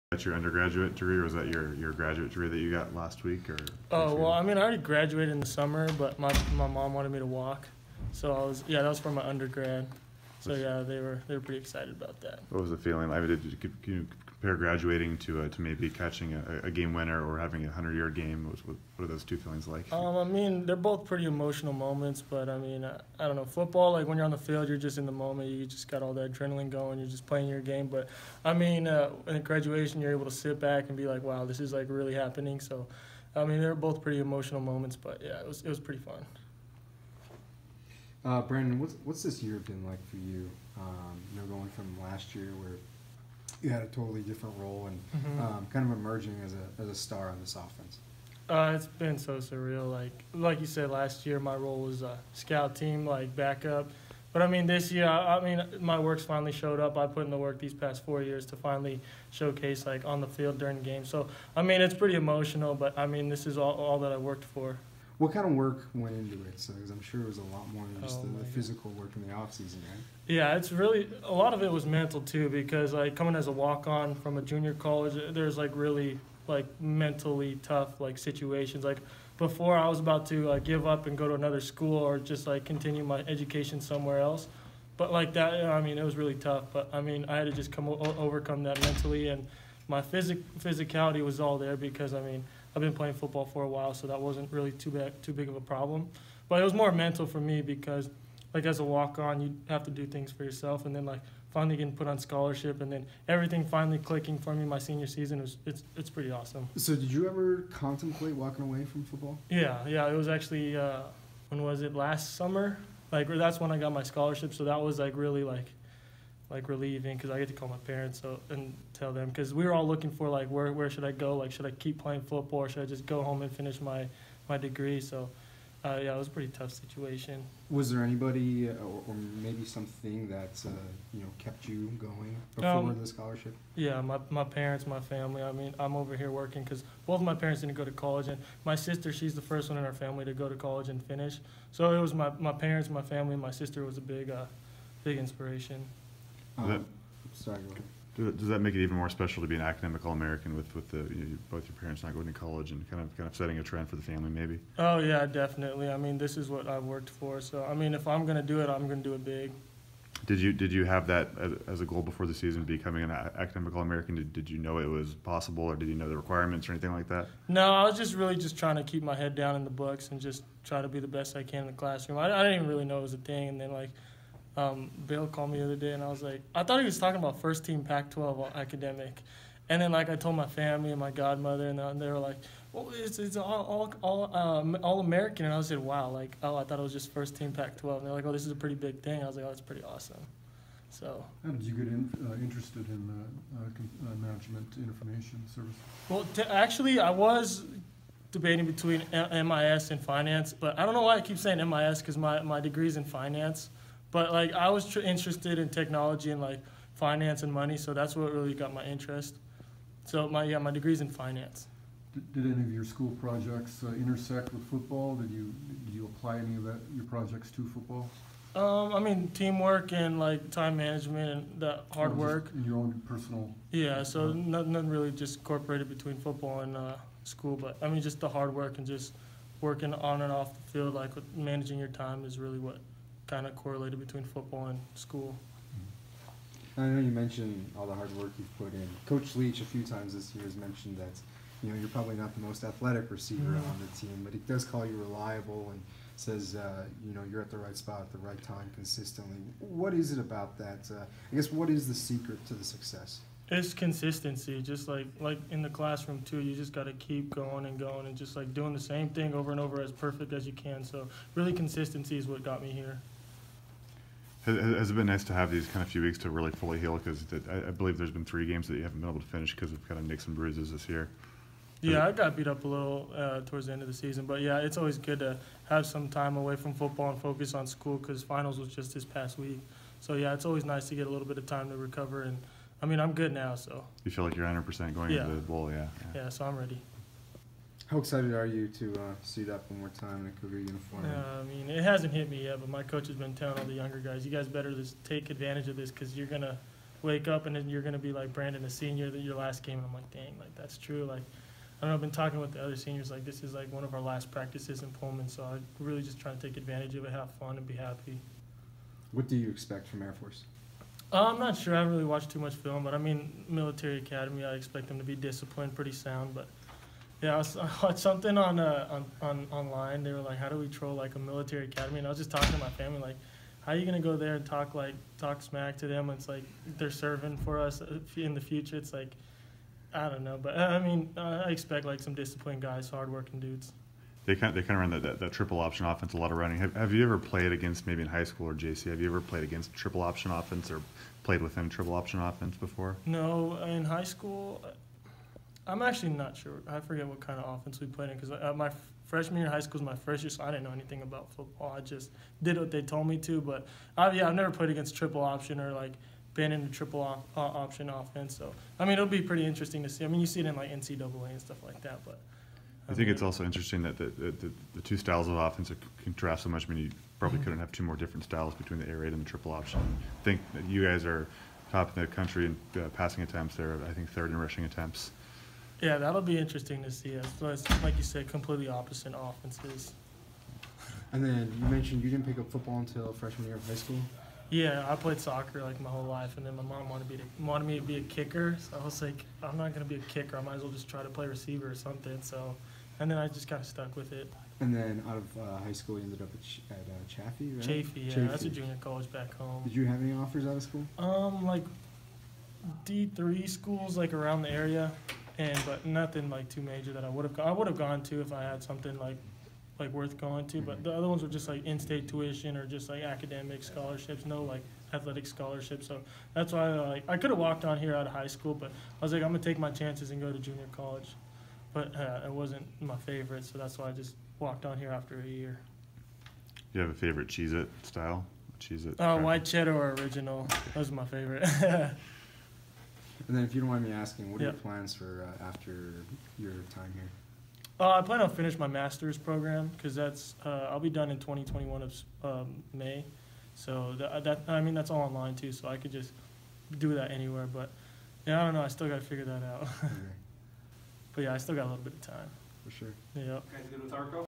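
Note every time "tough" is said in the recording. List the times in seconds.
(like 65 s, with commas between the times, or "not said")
77 s, 86 s, 126 s.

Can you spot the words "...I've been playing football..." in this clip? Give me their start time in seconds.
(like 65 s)
92 s.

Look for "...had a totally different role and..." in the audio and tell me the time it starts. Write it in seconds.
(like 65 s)
43 s.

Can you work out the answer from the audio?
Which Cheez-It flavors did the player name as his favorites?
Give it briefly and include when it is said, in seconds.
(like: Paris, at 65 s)
White cheddar or original, at 429 s.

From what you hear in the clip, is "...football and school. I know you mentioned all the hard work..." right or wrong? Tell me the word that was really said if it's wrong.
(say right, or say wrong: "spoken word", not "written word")
right.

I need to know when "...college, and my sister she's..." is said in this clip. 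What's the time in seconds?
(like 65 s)
137 s.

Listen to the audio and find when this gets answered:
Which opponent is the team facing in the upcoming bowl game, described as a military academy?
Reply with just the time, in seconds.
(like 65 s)
310 s.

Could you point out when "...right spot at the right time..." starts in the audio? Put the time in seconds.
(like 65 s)
247 s.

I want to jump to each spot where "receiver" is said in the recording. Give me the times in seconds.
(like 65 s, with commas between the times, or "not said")
243 s, 391 s.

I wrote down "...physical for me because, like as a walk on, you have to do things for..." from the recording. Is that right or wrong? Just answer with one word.
wrong.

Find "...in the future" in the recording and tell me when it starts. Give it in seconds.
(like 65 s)
328 s.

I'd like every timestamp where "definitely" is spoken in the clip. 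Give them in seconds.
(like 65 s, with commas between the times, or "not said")
155 s.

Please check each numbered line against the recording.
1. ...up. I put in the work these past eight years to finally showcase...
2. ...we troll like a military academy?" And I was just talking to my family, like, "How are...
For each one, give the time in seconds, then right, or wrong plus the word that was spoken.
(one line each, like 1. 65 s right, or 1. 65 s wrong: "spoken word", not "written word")
1. 56 s wrong: "four", not "eight"
2. 320 s right.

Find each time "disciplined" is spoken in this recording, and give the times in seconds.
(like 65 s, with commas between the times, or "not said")
315 s, 332 s.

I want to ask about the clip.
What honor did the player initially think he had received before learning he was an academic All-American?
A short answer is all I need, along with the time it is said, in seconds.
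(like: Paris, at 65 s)
First team Pac 12 academic, at 177 s.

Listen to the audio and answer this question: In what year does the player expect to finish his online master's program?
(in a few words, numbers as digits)
2021.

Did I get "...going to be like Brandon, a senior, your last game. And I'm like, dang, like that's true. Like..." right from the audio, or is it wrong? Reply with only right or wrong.
right.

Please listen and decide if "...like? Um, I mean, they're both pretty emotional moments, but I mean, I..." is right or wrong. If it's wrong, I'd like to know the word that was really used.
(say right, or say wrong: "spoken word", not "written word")
right.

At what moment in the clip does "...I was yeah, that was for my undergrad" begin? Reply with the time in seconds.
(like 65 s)
8 s.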